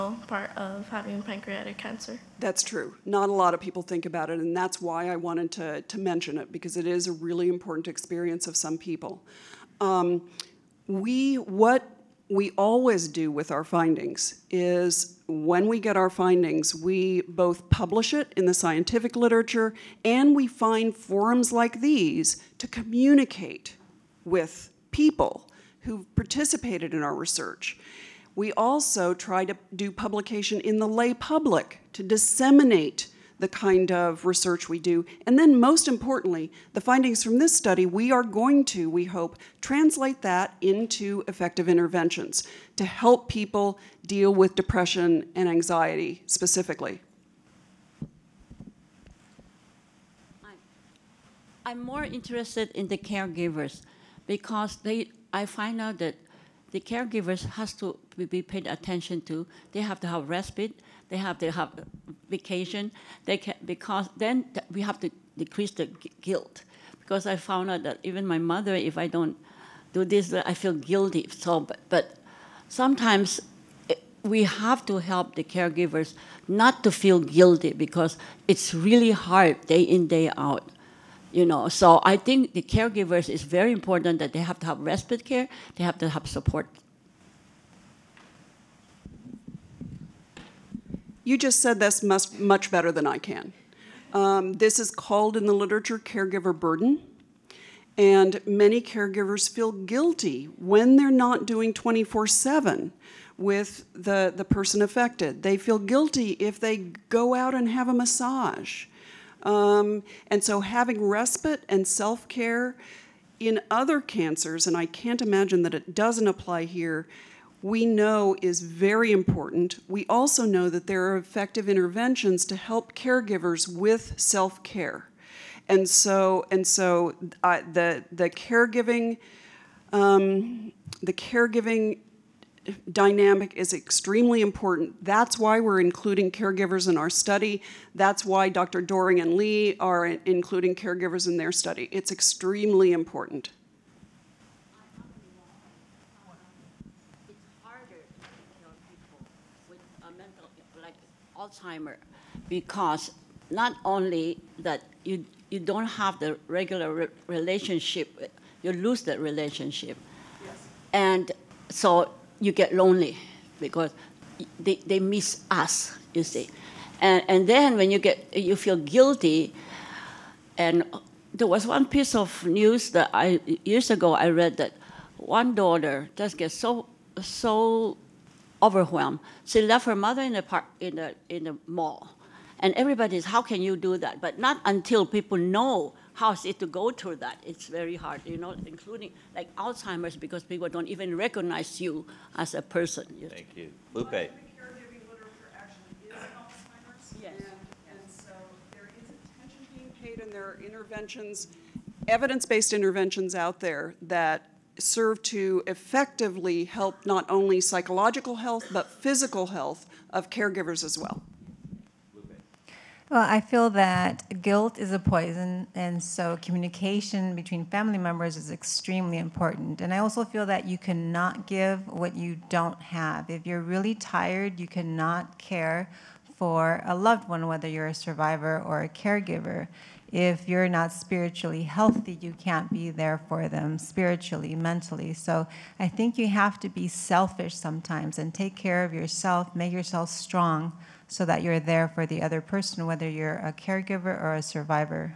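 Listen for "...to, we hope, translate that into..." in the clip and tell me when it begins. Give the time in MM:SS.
00:38.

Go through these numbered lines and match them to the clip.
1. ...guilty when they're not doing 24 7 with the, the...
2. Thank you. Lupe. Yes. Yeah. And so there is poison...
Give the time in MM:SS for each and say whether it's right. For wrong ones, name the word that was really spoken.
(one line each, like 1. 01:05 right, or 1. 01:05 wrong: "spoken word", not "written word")
1. 01:39 right
2. 03:13 wrong: "attention", not "poison".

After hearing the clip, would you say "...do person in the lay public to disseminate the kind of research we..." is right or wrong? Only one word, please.
wrong.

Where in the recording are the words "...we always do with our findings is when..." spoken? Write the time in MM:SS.
00:12.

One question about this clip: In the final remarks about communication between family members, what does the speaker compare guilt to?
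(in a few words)
a poison.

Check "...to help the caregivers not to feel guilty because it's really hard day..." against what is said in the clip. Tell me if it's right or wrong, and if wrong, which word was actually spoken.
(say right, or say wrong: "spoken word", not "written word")
right.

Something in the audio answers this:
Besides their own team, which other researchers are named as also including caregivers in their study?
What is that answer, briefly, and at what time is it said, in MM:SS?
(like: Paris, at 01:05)
Dr. Doring and Lee, at 02:18.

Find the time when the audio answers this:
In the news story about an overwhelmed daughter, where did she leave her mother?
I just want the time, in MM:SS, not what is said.
03:01.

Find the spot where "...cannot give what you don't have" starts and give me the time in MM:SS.
03:40.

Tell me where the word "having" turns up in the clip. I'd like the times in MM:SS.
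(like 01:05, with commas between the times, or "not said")
00:00, 01:50.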